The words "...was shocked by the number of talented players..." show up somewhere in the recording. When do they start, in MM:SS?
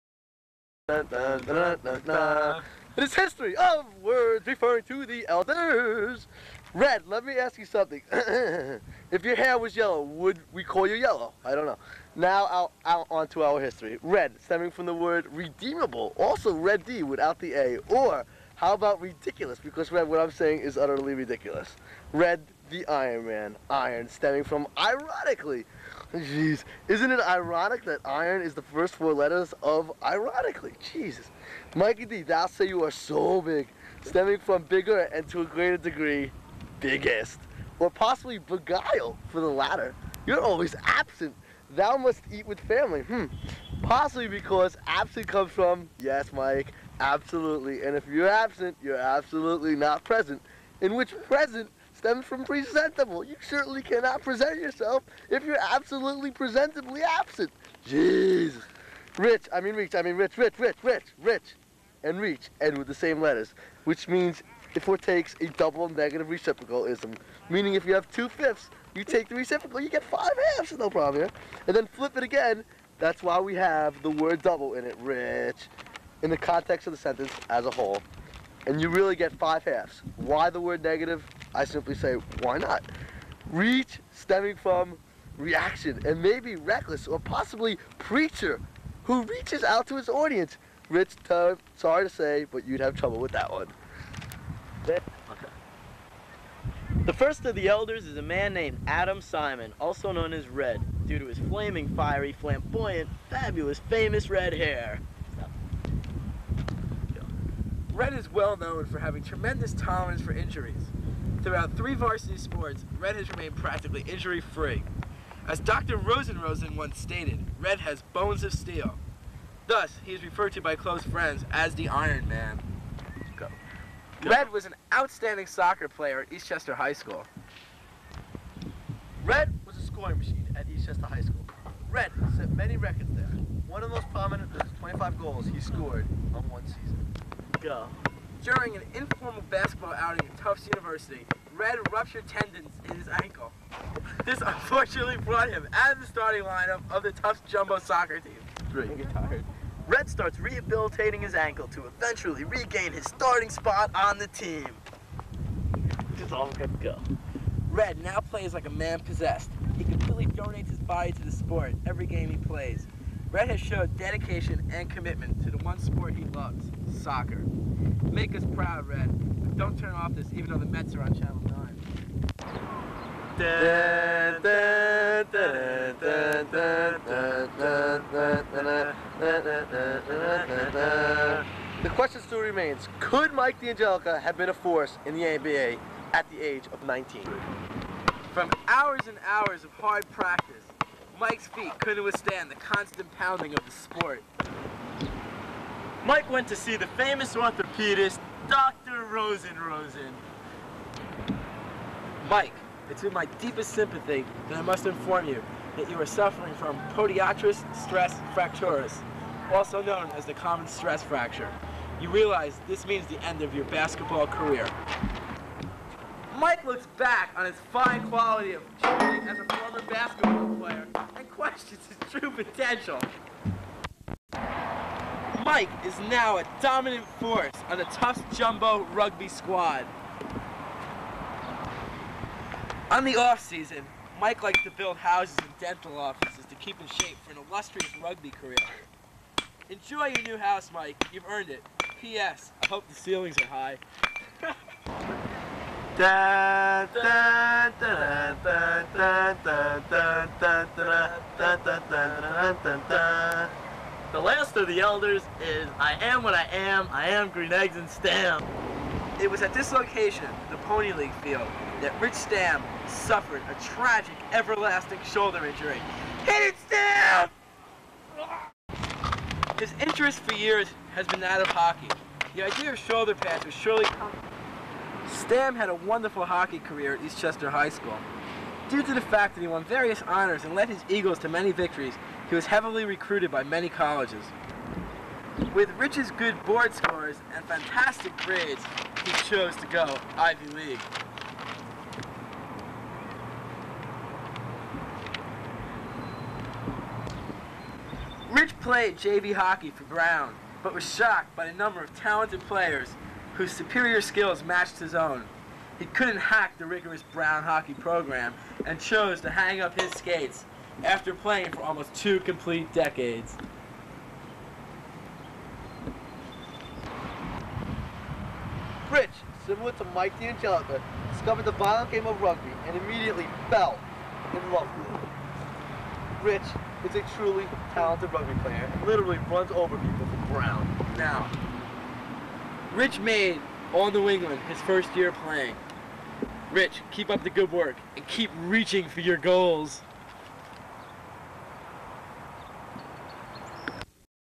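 05:00.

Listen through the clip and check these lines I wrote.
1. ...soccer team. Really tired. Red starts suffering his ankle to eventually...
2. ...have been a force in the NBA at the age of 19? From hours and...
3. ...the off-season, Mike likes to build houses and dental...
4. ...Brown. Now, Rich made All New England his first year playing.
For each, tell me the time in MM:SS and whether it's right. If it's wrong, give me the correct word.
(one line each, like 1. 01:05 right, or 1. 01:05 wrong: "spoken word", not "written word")
1. 02:27 wrong: "rehabilitating", not "suffering"
2. 03:04 right
3. 03:53 right
4. 05:30 right.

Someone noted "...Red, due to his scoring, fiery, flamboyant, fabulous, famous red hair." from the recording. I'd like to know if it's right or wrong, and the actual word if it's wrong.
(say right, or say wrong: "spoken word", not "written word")
wrong: "flaming", not "scoring".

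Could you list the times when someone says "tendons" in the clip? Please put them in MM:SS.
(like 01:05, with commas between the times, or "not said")
02:22.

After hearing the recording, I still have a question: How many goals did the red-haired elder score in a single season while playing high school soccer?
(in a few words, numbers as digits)
25.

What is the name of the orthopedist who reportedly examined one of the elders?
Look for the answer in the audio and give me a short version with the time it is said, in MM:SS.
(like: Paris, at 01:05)
Dr. Rosen Rosen, at 03:18.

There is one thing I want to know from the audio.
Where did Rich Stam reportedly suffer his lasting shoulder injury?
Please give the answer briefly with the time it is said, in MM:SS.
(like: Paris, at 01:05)
Pony League field, at 04:20.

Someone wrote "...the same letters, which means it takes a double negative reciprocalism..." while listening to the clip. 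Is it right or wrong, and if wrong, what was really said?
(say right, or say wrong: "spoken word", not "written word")
right.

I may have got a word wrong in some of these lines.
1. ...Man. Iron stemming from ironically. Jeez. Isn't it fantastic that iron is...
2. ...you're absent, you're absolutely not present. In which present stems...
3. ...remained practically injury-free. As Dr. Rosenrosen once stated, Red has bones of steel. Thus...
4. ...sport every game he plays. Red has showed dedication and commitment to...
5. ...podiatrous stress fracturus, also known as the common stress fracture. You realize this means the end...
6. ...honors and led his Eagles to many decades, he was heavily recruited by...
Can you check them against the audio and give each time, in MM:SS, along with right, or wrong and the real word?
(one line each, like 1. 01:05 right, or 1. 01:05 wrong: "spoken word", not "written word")
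1. 00:23 wrong: "ironic", not "fantastic"
2. 00:48 right
3. 01:53 right
4. 02:41 right
5. 03:26 right
6. 04:40 wrong: "victories", not "decades".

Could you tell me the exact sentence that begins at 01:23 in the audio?
Reach stemming from reaction, and maybe reckless or possibly preacher who reaches out to his audience.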